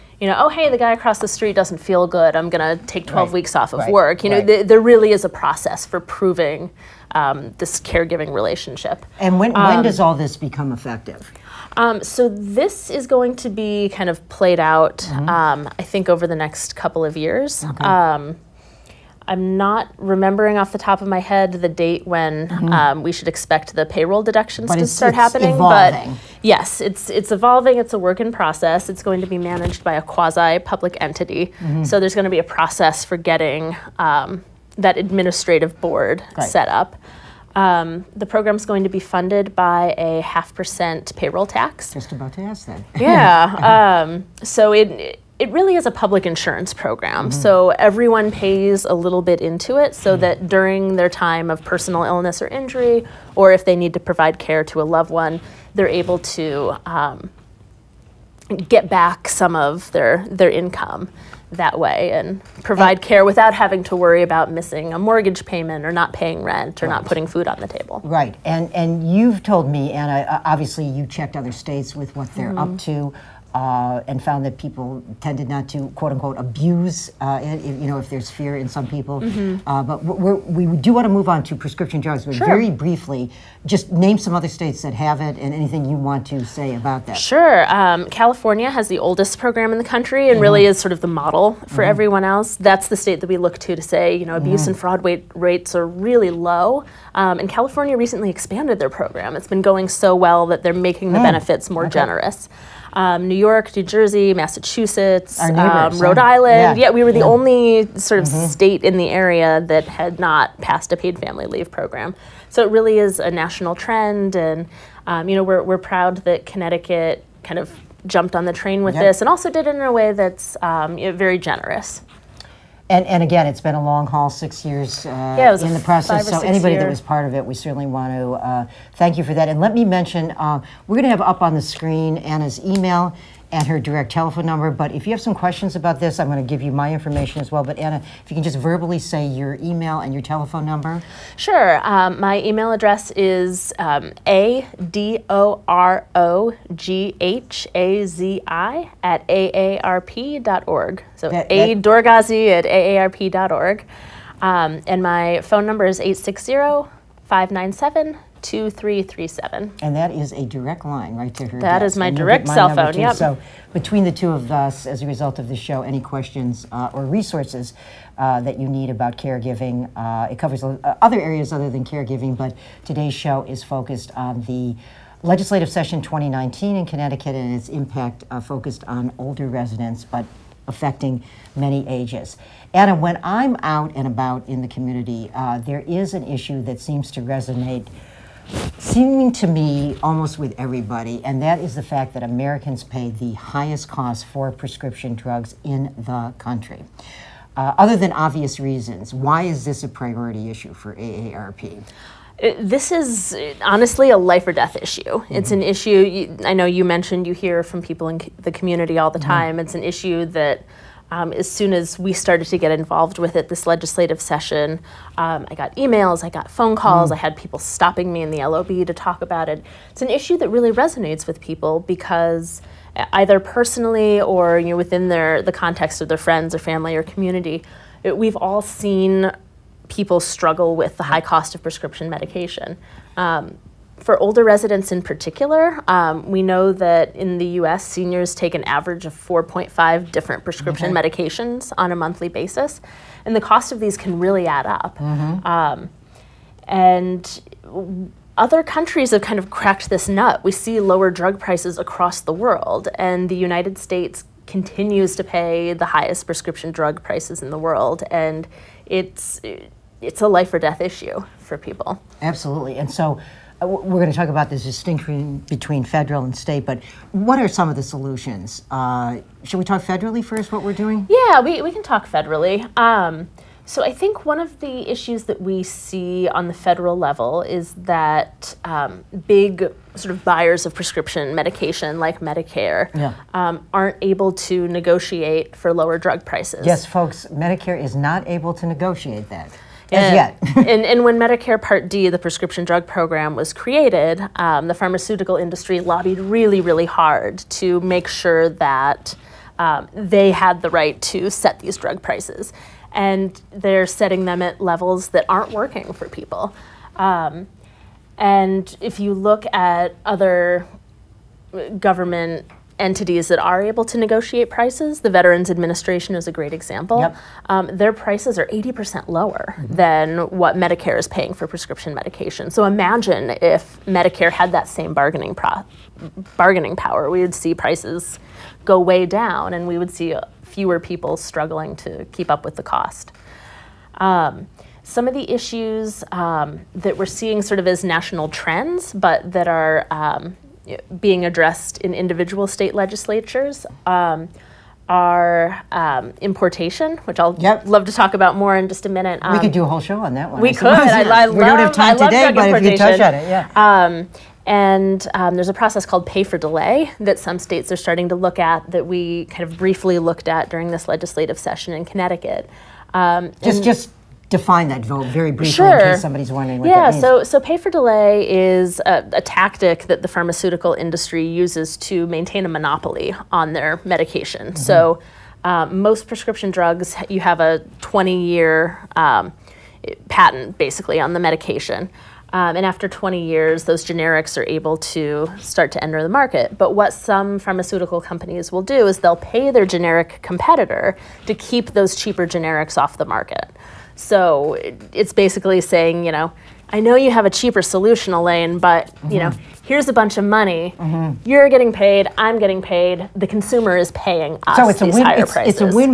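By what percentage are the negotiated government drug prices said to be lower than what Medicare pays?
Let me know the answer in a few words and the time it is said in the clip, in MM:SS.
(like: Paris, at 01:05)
80%, at 05:18.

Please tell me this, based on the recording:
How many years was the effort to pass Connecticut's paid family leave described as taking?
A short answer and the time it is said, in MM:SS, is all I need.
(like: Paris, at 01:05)
6, at 02:04.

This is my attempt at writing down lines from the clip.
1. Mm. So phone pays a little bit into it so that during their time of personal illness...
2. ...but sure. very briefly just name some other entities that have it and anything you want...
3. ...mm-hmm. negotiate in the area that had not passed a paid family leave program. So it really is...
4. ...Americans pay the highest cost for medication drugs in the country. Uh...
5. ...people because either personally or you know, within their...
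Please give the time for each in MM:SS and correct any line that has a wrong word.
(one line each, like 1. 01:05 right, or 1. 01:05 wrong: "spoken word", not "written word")
1. 00:47 wrong: "everyone", not "phone"
2. 01:22 wrong: "states", not "entities"
3. 01:48 wrong: "state", not "negotiate"
4. 03:12 wrong: "prescription", not "medication"
5. 03:41 right.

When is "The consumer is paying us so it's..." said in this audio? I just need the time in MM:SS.
06:43.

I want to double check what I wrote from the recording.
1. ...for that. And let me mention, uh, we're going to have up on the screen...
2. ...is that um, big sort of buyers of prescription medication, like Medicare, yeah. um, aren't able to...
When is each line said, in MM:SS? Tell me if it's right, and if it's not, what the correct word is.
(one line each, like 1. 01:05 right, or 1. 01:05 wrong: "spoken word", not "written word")
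1. 02:09 right
2. 04:37 right.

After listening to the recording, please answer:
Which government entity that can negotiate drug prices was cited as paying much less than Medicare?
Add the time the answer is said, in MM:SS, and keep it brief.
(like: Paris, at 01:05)
Veterans Administration, at 05:15.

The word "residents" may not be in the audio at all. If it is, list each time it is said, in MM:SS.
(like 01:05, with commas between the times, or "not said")
02:59, 03:54.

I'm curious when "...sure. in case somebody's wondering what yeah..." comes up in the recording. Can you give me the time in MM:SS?
06:05.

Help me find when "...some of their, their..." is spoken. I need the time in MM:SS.
00:59.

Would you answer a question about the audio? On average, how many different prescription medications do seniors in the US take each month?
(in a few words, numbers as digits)
4.5.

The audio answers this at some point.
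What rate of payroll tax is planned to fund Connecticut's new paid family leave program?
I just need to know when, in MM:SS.
00:40.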